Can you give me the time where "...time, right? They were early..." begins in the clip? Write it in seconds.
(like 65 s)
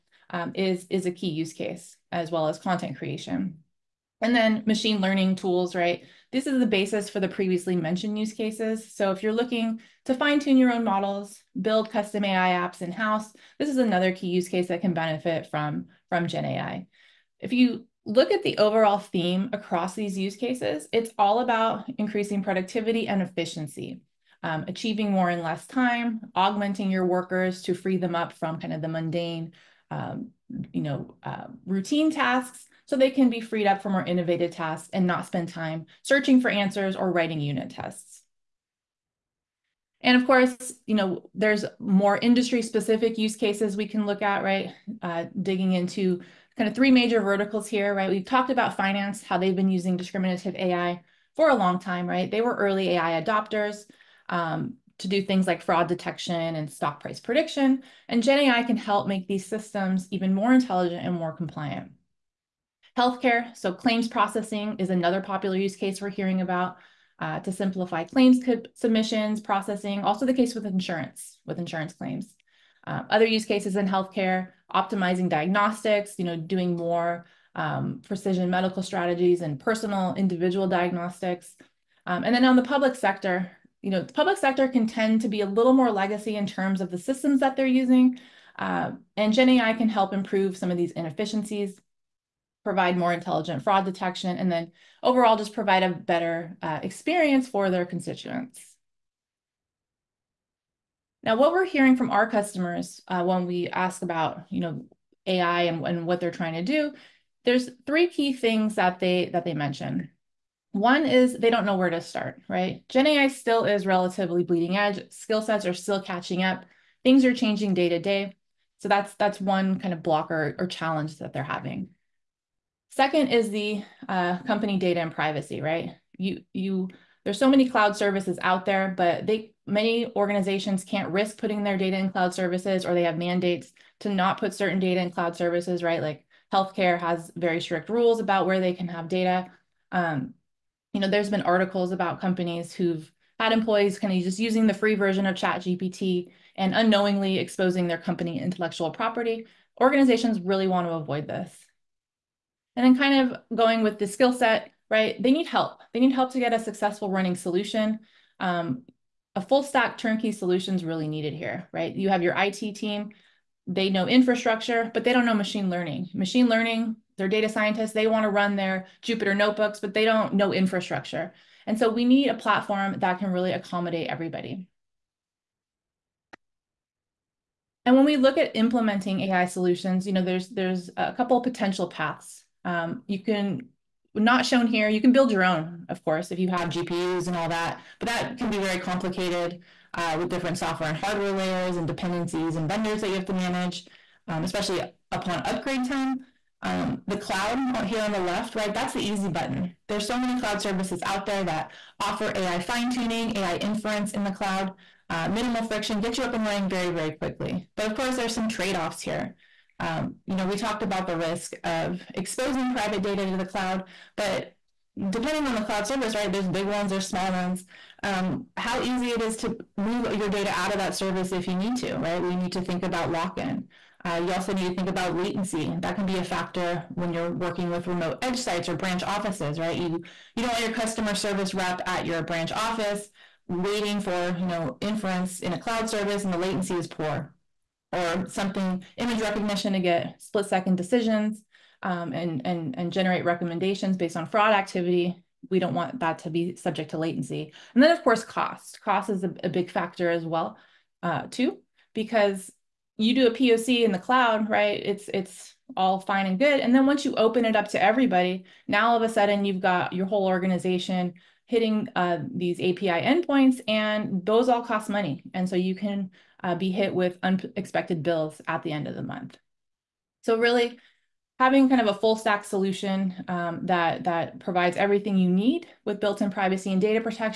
51 s.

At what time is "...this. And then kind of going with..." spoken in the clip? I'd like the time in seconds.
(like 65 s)
151 s.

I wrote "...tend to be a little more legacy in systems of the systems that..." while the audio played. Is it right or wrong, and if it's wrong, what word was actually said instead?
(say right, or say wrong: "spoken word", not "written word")
wrong: "terms", not "systems".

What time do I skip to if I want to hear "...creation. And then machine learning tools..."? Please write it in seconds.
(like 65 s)
2 s.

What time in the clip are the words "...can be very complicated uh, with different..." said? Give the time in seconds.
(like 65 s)
188 s.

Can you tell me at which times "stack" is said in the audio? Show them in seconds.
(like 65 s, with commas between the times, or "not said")
159 s, 272 s.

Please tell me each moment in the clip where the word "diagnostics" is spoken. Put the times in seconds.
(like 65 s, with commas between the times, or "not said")
75 s, 80 s.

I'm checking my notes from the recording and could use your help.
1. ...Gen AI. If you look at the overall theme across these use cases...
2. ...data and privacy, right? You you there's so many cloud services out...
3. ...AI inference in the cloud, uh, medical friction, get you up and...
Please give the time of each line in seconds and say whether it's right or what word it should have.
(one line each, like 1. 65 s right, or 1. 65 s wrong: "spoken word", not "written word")
1. 16 s right
2. 124 s right
3. 203 s wrong: "minimal", not "medical".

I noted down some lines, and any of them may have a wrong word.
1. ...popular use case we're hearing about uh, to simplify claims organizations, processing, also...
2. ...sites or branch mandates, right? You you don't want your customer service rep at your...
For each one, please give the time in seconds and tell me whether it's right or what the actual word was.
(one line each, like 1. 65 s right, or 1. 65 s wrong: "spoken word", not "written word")
1. 65 s wrong: "submissions", not "organizations"
2. 228 s wrong: "offices", not "mandates".